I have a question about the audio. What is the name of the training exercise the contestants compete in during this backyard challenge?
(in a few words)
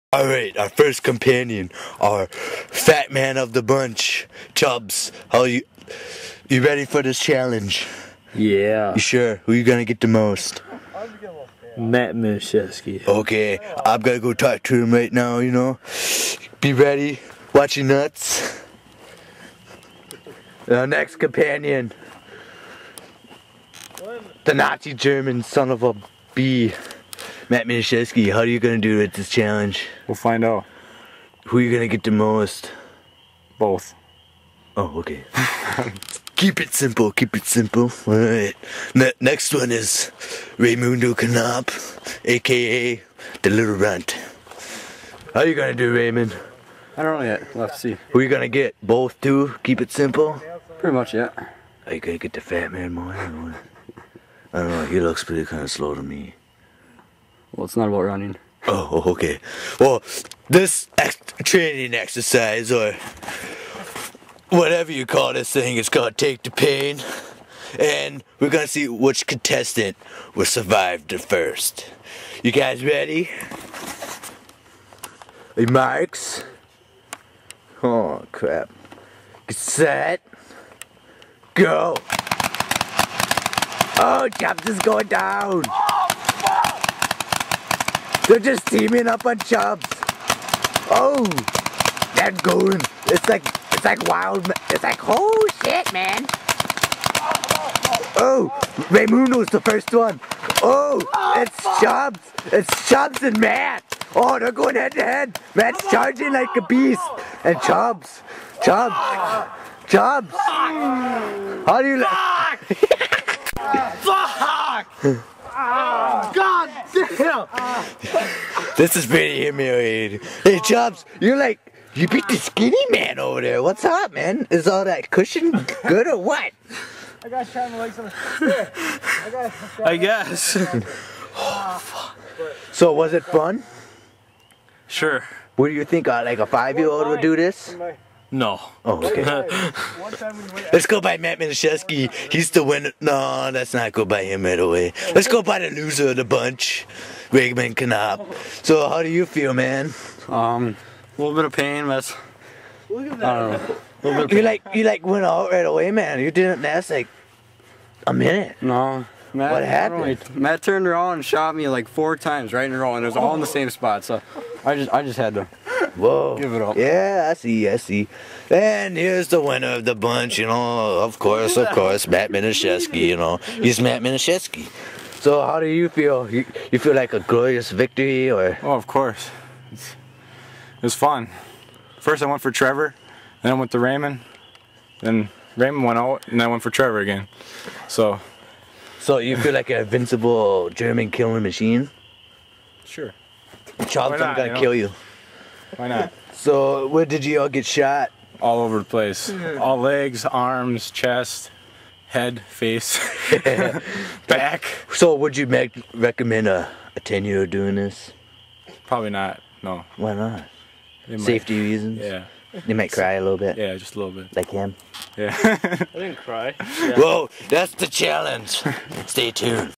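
Take the Pain.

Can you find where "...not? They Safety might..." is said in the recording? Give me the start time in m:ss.
3:30.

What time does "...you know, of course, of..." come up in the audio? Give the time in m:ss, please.
2:50.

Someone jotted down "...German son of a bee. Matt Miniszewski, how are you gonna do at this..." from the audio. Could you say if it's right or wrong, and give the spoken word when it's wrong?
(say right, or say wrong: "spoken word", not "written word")
right.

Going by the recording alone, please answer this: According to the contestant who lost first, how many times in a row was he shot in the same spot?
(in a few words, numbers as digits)
4.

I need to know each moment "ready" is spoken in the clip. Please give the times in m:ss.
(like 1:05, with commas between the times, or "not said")
0:06, 0:16, 1:12.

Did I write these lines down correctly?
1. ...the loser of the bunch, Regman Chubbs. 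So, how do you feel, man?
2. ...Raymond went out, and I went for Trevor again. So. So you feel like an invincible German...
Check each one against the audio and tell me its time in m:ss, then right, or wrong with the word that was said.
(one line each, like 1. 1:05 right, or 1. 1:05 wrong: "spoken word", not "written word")
1. 2:25 wrong: "Knaup", not "Chubbs"
2. 3:05 right.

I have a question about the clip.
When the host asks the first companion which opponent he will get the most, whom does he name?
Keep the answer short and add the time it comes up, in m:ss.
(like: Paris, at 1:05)
Matt Mishesky, at 0:11.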